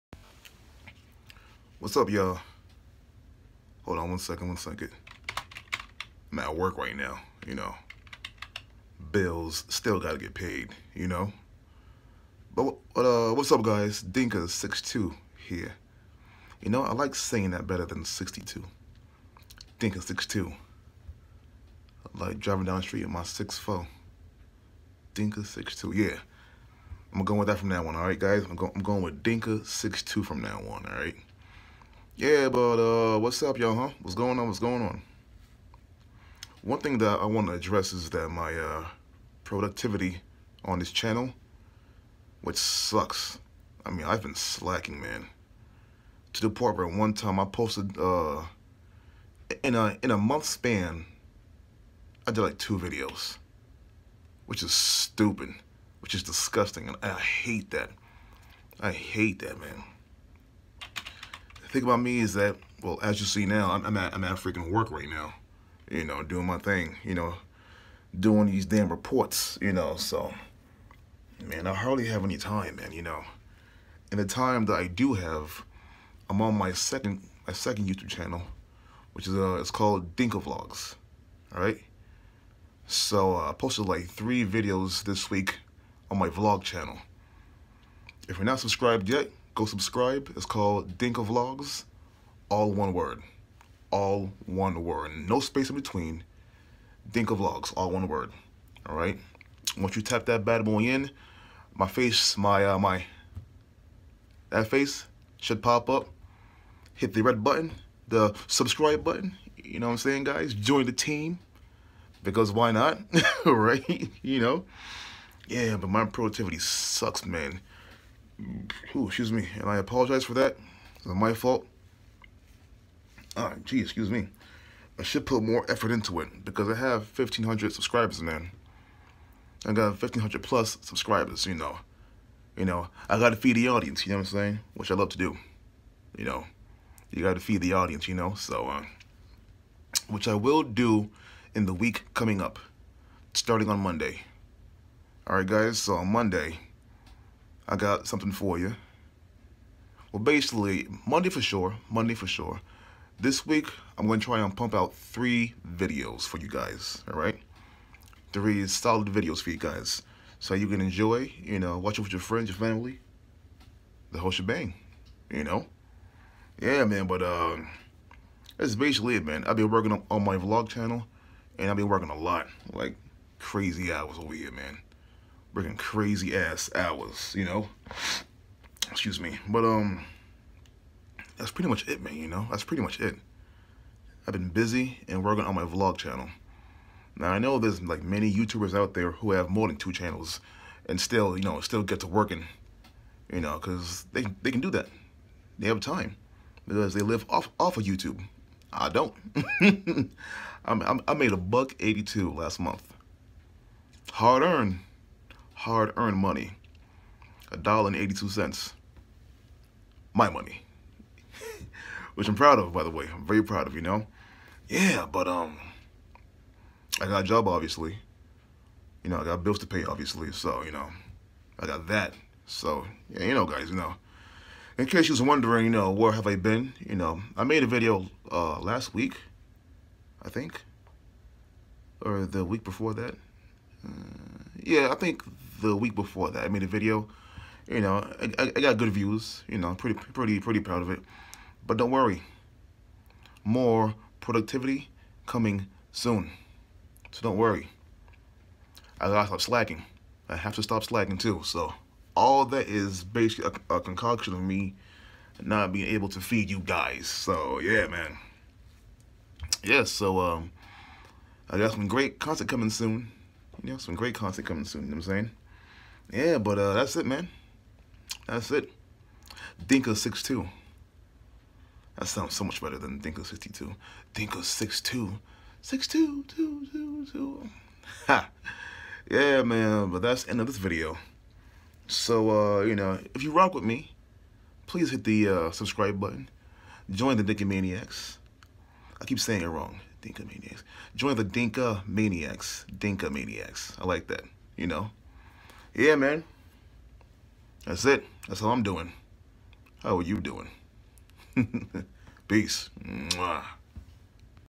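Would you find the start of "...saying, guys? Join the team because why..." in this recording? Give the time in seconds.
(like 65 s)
109 s.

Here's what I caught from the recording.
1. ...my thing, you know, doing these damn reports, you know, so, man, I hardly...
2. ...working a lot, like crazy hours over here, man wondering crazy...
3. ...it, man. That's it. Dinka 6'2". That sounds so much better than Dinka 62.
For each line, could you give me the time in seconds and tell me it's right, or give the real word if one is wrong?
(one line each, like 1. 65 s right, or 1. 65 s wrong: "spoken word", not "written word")
1. 66 s right
2. 171 s wrong: "working", not "wondering"
3. 266 s right.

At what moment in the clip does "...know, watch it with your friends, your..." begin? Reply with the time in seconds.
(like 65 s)
161 s.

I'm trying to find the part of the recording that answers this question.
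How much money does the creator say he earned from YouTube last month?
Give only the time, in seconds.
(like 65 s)
207 s.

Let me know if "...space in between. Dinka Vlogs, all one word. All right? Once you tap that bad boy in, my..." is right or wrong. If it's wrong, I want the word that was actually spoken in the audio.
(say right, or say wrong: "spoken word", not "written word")
right.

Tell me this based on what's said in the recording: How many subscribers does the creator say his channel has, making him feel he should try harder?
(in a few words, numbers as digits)
1,500.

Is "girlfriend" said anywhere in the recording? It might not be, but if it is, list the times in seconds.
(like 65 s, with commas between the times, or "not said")
not said.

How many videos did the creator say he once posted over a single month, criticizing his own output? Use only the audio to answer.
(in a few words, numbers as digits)
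2.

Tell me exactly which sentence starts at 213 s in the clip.
I'm very proud of, you know?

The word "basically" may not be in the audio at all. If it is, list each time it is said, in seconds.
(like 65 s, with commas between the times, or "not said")
150 s, 168 s, 253 s.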